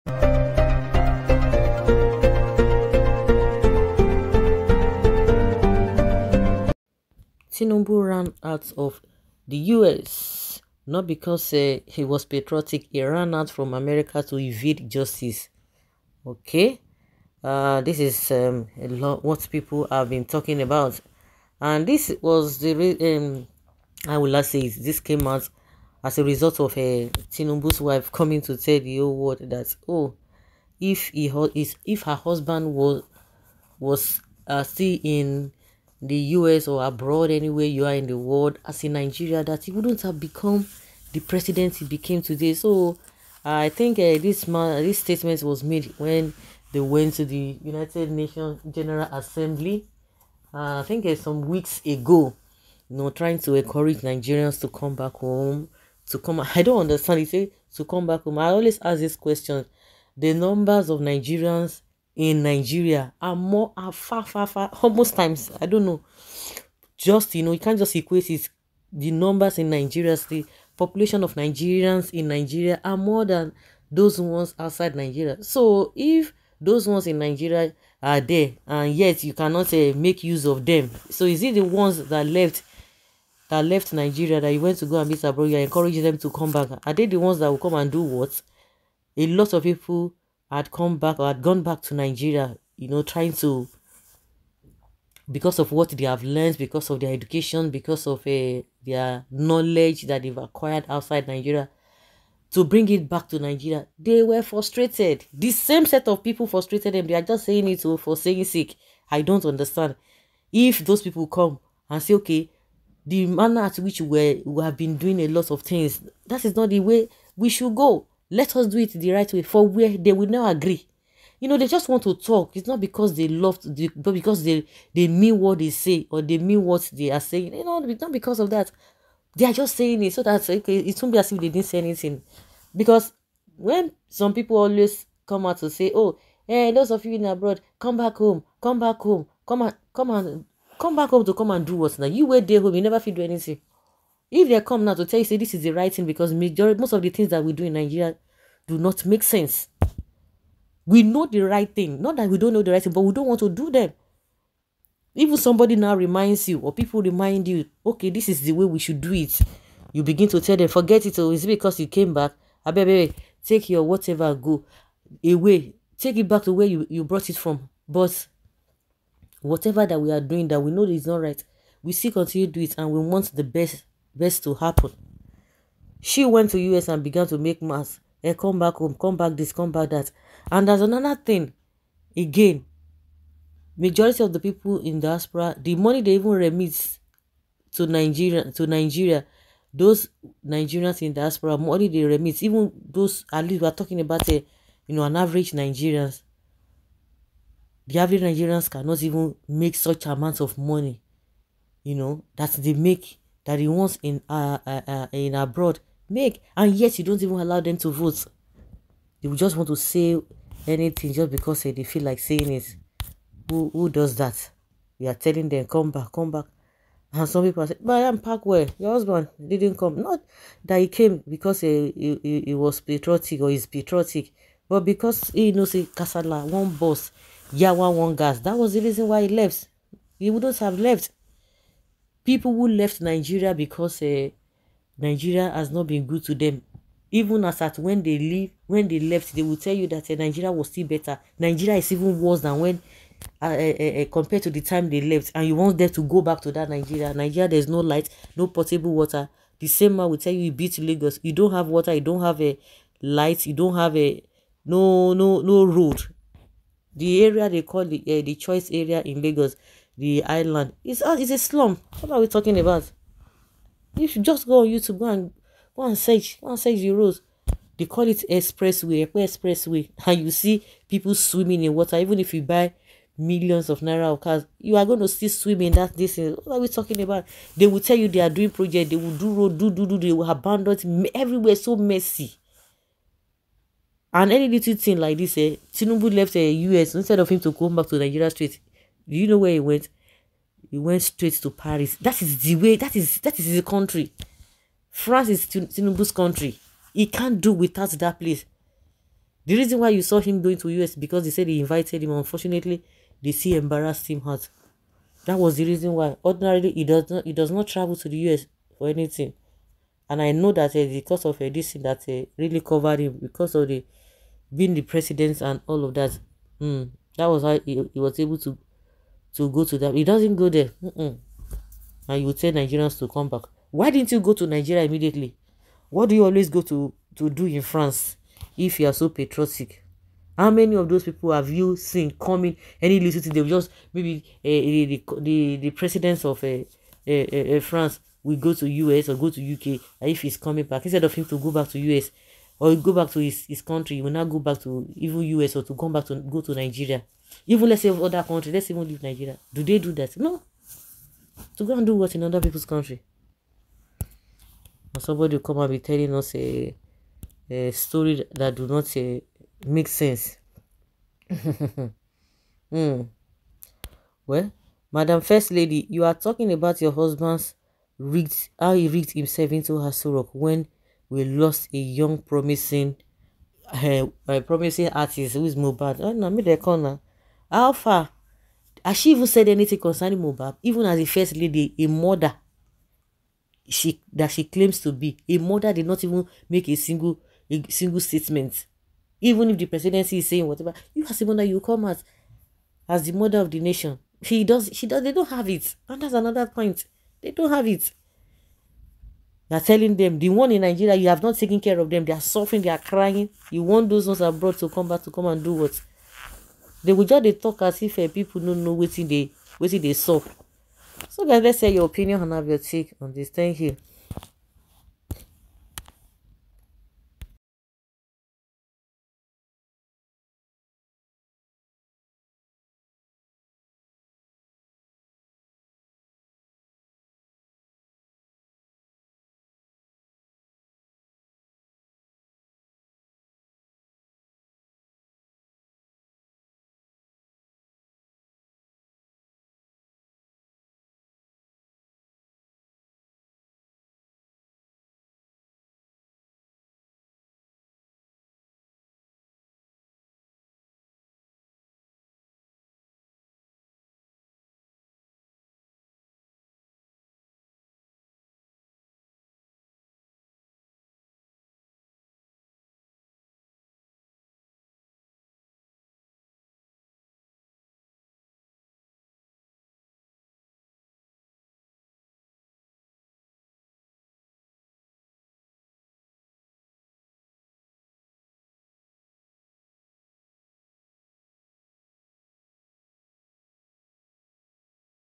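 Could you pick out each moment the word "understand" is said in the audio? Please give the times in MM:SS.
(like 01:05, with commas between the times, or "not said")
00:56, 01:49.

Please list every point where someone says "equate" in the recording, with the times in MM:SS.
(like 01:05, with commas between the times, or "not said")
01:07.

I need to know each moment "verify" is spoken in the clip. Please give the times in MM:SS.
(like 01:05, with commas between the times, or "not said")
not said.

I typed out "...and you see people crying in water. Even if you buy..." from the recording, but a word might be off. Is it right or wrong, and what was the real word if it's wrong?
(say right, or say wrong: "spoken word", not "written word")
wrong: "swimming", not "crying".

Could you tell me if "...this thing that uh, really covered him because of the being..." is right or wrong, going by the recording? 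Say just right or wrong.
right.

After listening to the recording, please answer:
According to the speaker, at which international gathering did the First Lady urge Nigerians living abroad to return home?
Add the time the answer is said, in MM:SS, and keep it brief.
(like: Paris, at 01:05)
United Nations General Assembly, at 00:47.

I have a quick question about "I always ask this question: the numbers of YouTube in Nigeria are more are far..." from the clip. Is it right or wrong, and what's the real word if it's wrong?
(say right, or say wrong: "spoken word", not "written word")
wrong: "Nigerians", not "YouTube".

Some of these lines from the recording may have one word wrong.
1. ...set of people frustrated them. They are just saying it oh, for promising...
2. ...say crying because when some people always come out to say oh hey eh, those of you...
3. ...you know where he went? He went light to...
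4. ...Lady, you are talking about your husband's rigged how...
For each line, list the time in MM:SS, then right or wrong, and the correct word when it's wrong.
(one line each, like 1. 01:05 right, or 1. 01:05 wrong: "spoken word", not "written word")
1. 01:45 wrong: "saying", not "promising"
2. 02:11 wrong: "anything", not "crying"
3. 04:49 wrong: "straight", not "light"
4. 06:05 right.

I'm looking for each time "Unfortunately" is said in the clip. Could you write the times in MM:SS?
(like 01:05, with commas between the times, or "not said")
05:02.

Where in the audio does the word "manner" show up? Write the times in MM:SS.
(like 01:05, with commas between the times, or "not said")
01:53.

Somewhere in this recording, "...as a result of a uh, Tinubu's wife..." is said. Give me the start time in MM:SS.
00:26.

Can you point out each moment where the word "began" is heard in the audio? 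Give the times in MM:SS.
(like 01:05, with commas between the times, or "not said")
02:57.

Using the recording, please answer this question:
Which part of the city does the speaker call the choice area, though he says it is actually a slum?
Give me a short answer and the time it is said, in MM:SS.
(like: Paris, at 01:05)
the island, at 04:19.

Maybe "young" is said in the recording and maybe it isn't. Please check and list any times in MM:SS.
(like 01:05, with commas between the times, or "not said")
06:11.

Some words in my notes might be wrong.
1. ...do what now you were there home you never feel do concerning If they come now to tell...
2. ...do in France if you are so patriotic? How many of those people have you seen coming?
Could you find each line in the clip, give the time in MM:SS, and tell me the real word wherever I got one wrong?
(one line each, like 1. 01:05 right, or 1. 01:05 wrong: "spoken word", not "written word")
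1. 02:21 wrong: "anything", not "concerning"
2. 05:27 right.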